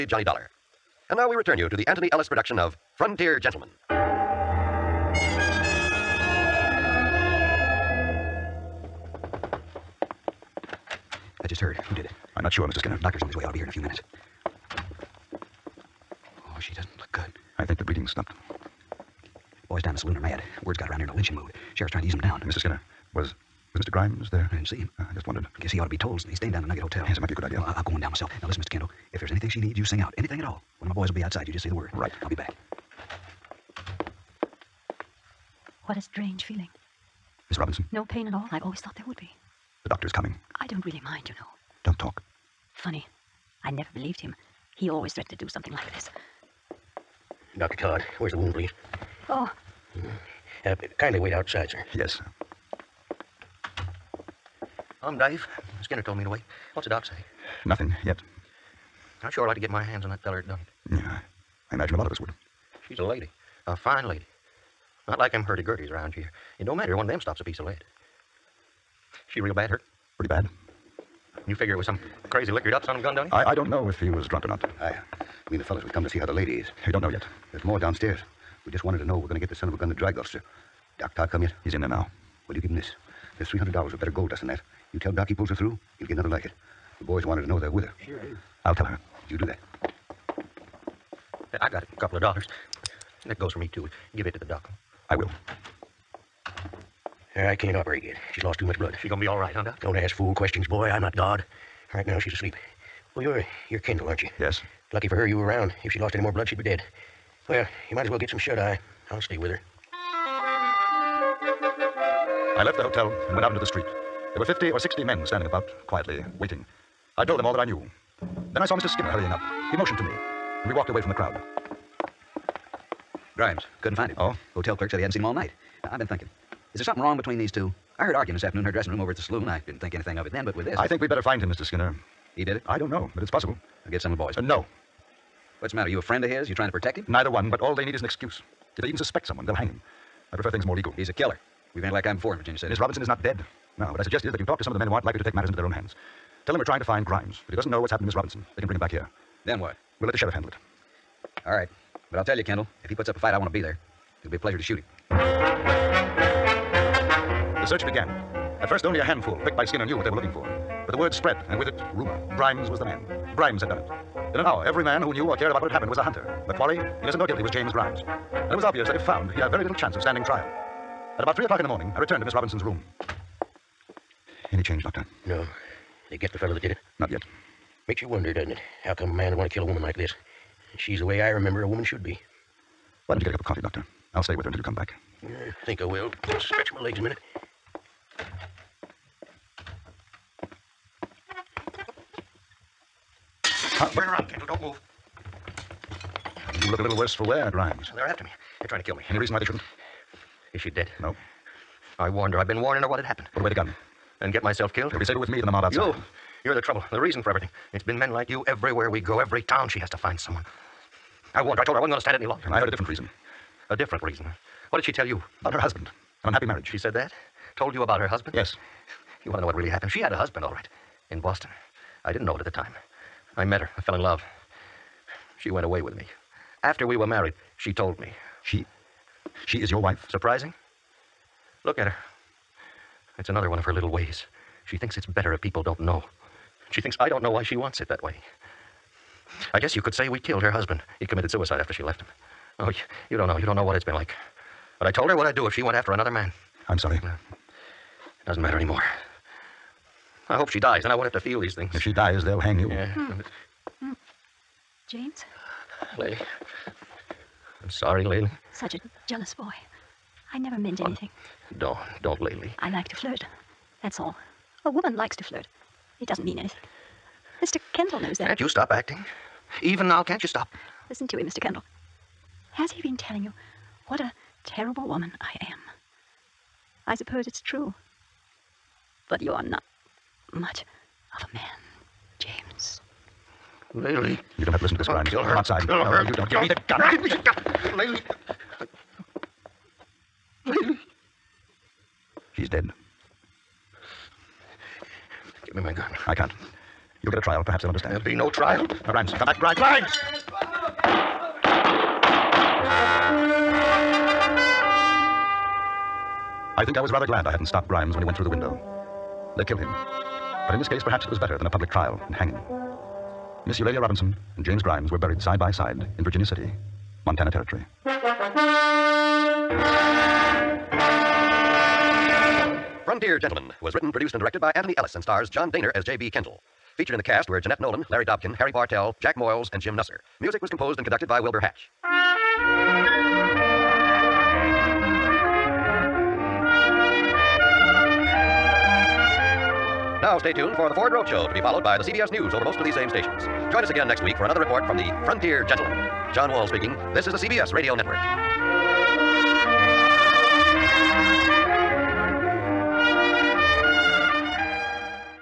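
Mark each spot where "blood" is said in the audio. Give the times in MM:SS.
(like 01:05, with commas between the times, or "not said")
01:38, 01:46.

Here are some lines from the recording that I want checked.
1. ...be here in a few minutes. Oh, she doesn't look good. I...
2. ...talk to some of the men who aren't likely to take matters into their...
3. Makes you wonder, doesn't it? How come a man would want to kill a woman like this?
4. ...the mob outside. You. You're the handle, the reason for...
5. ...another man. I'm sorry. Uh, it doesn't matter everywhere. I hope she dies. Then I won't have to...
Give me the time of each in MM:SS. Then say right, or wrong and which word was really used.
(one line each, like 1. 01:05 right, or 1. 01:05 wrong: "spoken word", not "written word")
1. 00:13 right
2. 02:24 right
3. 02:57 right
4. 03:25 wrong: "trouble", not "handle"
5. 04:05 wrong: "anymore", not "everywhere".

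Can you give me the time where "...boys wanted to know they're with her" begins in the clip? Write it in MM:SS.
01:27.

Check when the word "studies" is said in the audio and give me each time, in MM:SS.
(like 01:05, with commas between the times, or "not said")
not said.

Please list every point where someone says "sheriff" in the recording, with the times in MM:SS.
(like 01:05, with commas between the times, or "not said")
00:21, 02:30.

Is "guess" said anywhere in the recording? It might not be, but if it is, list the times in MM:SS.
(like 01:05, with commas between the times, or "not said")
00:25, 03:59.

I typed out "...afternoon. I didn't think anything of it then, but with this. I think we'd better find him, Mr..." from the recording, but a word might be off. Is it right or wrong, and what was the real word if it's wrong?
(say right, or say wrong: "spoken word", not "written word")
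wrong: "saloon", not "afternoon".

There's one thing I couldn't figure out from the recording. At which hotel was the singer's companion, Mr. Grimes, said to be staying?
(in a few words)
Nugget Hotel.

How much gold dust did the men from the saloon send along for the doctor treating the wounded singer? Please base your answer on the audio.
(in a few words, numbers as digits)
$300.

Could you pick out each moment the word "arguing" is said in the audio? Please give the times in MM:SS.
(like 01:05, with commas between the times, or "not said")
02:08.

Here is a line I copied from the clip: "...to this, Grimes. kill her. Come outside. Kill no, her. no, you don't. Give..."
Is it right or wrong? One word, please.
right.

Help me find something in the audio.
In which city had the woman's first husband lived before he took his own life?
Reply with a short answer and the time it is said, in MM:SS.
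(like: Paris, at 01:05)
Boston, at 03:41.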